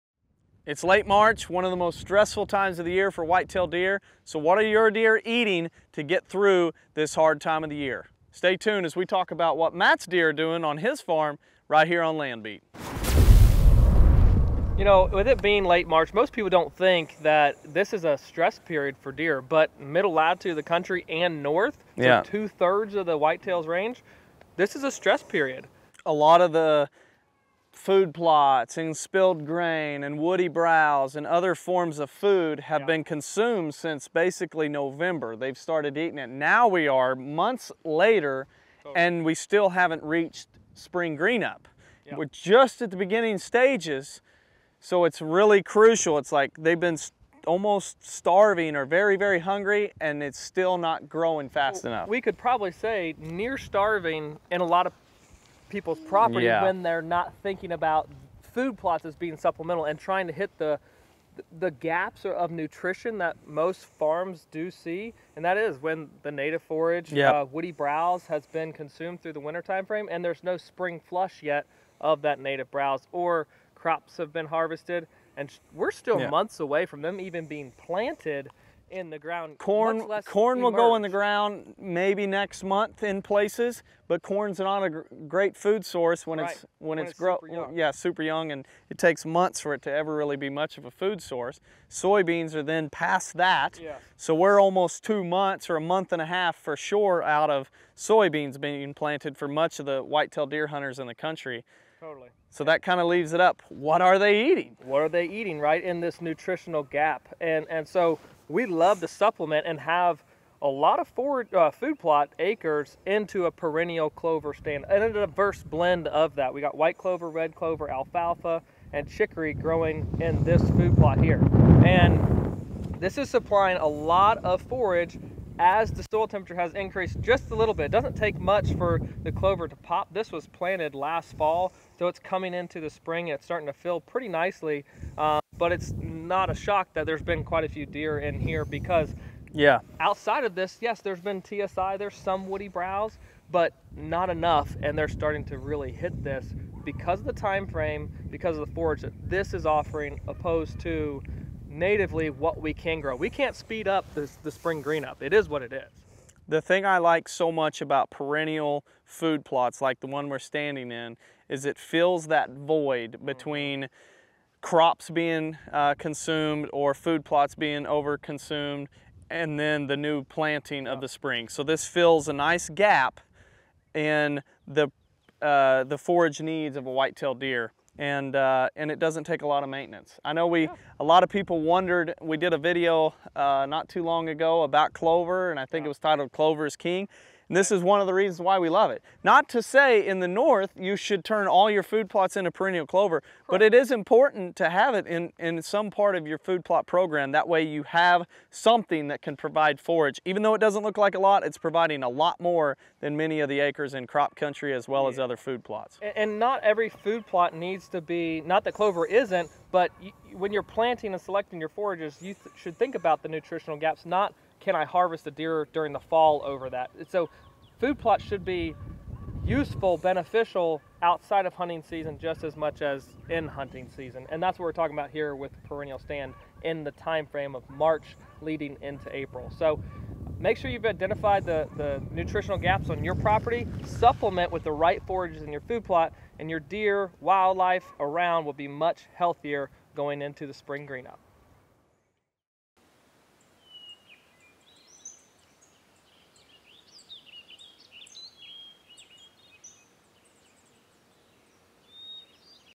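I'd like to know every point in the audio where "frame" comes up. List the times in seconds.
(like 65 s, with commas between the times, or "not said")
69 s, 147 s, 227 s.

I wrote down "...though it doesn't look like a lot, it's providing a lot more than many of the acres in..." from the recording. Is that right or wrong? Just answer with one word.
right.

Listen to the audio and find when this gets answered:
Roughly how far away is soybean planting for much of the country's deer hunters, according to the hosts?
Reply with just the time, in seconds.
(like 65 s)
95 s.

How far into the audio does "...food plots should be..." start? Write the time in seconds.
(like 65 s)
217 s.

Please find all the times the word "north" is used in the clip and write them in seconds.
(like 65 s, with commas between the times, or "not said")
21 s, 190 s.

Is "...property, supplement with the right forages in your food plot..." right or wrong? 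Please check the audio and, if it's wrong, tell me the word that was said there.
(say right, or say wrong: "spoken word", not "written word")
right.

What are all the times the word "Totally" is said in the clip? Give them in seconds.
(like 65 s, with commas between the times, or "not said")
102 s.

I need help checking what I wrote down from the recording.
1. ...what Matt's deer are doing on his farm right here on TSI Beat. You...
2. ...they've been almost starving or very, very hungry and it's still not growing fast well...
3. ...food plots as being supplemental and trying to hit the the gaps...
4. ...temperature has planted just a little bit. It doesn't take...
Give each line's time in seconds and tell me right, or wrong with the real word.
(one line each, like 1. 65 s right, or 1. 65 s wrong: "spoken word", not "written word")
1. 9 s wrong: "Land", not "TSI"
2. 46 s right
3. 58 s right
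4. 126 s wrong: "increased", not "planted".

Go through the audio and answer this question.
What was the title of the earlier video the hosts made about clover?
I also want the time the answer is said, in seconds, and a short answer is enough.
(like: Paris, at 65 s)
Clover is King, at 186 s.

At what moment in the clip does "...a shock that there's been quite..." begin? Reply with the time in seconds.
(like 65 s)
136 s.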